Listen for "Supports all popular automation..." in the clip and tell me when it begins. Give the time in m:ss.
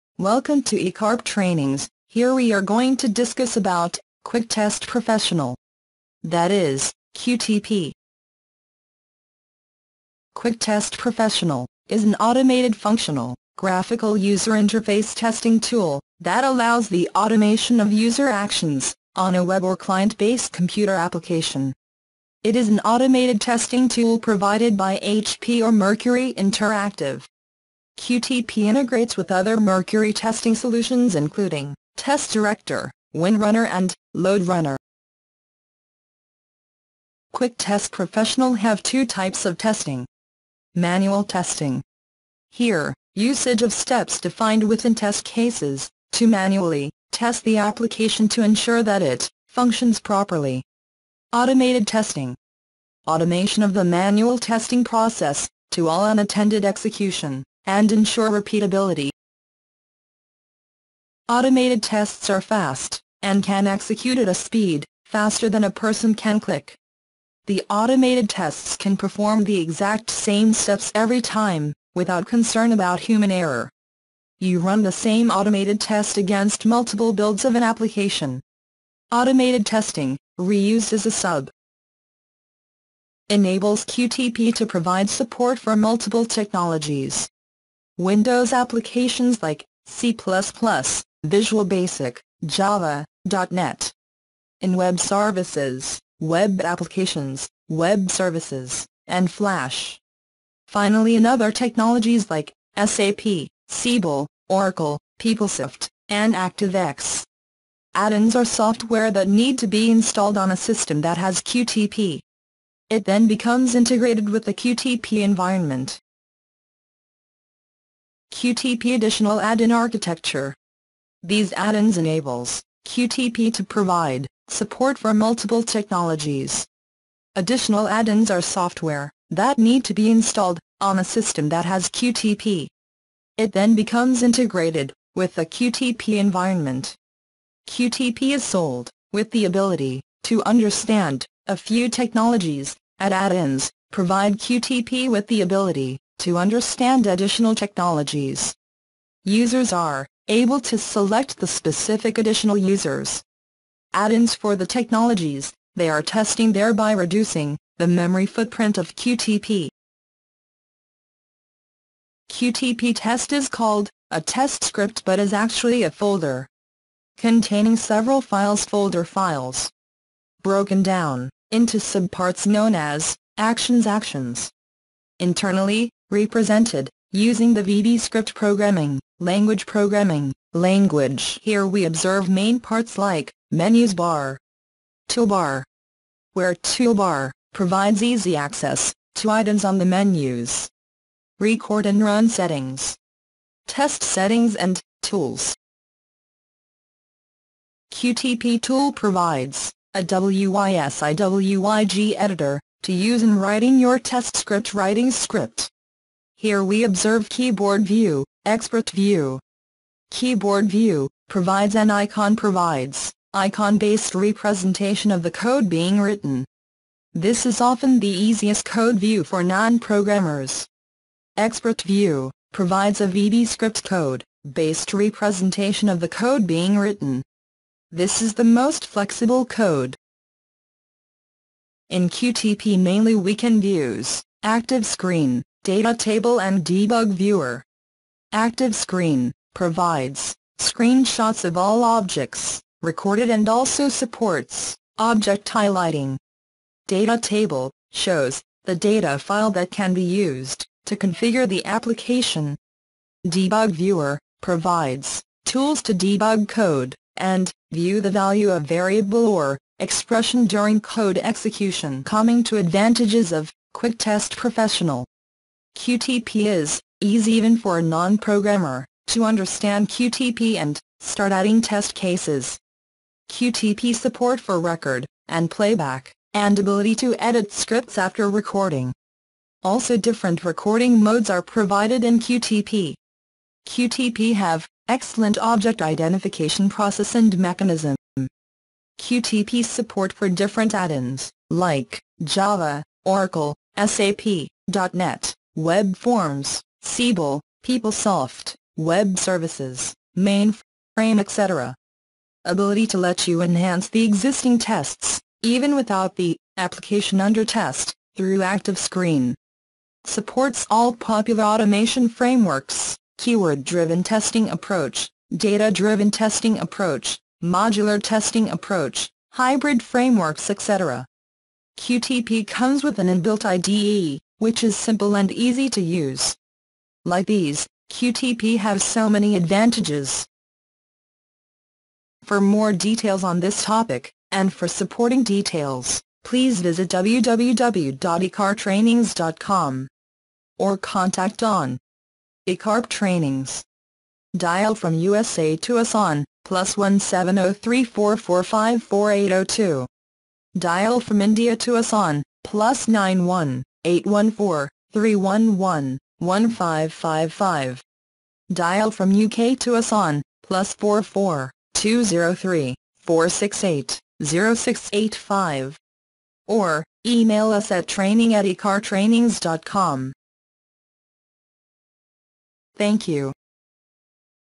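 5:10.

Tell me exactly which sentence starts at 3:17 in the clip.
QTP tool provides, a WYSIWYG editor, to use in writing your test script writing script.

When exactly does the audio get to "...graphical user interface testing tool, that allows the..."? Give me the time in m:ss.
0:13.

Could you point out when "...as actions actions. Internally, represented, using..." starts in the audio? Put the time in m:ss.
2:52.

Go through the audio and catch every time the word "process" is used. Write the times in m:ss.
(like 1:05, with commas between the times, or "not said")
0:54, 4:46.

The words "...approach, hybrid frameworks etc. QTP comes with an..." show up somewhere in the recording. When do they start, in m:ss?
5:18.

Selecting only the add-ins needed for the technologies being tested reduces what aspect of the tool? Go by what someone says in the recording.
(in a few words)
memory footprint.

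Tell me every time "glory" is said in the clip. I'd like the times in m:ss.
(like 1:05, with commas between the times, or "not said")
not said.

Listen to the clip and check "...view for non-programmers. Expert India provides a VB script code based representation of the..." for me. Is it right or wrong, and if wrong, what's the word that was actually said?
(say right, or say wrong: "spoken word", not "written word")
wrong: "View", not "India".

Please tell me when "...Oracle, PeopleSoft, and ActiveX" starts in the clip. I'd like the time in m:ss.
1:44.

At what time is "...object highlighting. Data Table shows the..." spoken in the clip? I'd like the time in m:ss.
4:04.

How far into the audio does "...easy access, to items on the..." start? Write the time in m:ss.
3:08.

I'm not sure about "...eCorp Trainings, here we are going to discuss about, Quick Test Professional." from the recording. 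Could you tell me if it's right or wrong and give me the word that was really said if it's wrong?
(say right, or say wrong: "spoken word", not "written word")
right.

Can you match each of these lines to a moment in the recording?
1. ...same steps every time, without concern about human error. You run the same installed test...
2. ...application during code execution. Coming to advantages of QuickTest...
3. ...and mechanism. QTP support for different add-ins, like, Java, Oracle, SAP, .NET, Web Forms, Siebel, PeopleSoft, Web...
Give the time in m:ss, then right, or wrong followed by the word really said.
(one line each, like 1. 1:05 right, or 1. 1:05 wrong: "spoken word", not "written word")
1. 1:10 wrong: "automated", not "installed"
2. 4:19 wrong: "expression", not "application"
3. 4:47 right.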